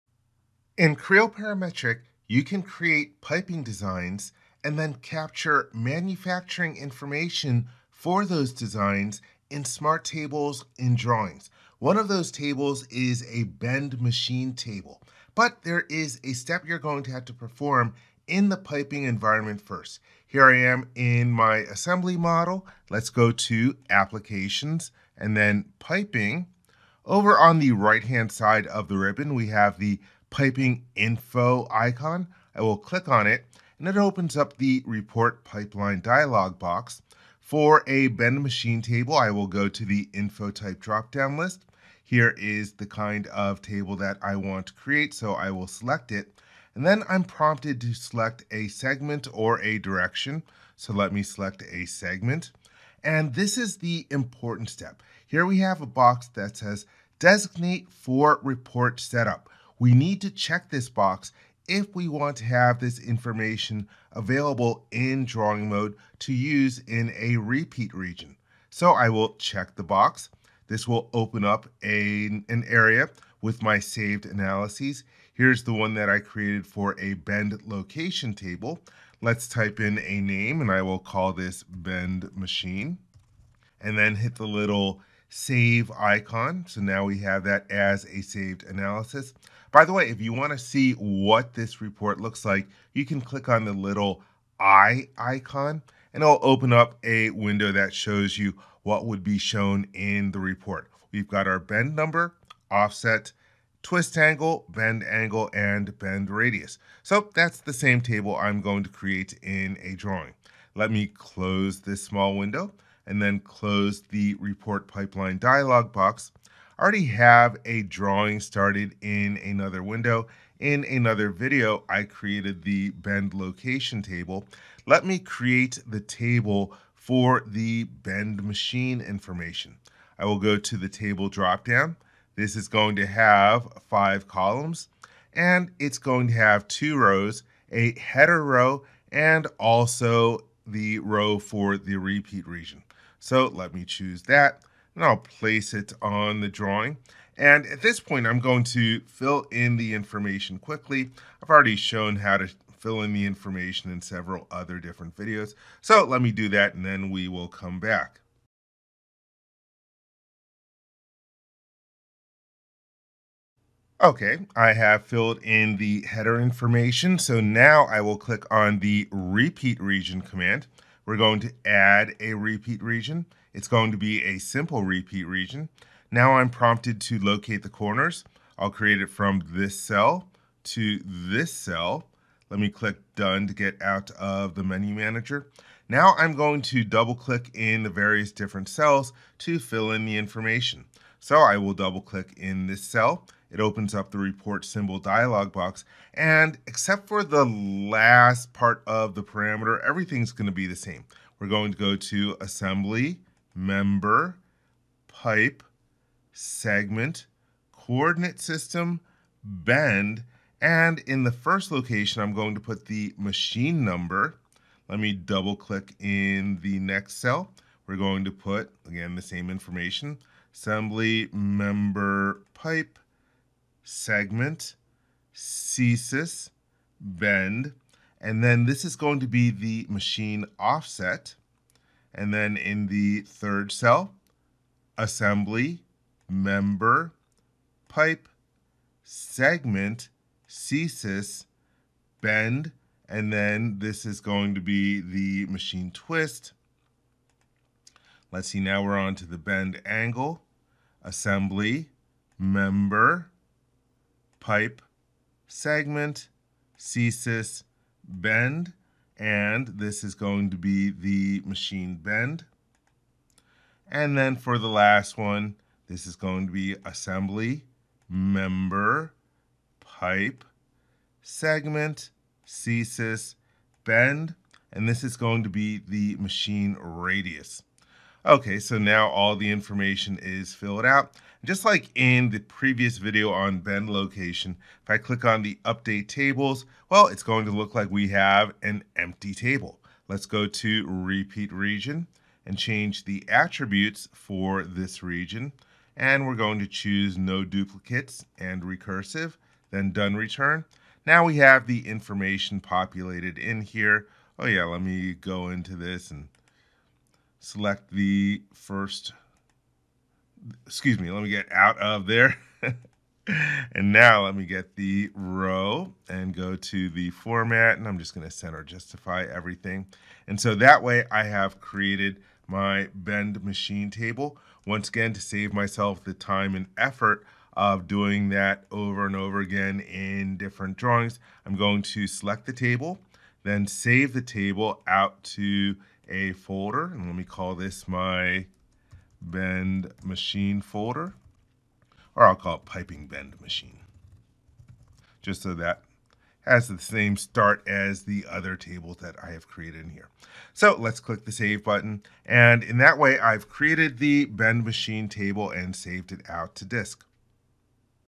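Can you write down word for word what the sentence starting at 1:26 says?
So now we have that as a saved analysis.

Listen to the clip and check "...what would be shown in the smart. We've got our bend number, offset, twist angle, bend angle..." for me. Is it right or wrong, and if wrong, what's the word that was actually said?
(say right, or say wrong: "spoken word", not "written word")
wrong: "report", not "smart".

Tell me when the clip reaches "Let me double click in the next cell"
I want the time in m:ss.
3:34.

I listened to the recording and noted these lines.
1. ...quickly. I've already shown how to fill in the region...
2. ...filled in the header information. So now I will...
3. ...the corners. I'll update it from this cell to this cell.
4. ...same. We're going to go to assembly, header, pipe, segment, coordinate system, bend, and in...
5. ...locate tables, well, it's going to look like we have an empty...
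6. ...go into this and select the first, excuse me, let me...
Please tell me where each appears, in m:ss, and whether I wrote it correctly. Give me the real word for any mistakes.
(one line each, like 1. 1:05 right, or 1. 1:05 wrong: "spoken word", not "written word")
1. 2:30 wrong: "information", not "region"
2. 2:45 right
3. 2:57 wrong: "create", not "update"
4. 3:20 wrong: "member", not "header"
5. 4:45 wrong: "update", not "locate"
6. 5:05 right.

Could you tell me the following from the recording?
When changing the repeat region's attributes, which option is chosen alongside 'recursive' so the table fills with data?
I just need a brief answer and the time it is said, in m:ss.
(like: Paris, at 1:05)
No duplicates, at 4:57.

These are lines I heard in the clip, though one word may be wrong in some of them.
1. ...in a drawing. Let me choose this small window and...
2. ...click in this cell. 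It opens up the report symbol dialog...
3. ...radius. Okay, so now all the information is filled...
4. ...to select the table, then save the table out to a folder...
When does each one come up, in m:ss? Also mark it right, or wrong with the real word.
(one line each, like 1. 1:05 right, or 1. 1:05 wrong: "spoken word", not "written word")
1. 1:49 wrong: "close", not "choose"
2. 3:12 right
3. 4:36 right
4. 5:31 right.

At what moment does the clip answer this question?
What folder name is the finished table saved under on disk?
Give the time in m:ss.
5:42.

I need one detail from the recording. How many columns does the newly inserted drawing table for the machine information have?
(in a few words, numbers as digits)
5.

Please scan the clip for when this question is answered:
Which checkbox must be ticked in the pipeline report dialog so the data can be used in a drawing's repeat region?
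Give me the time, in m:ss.
0:57.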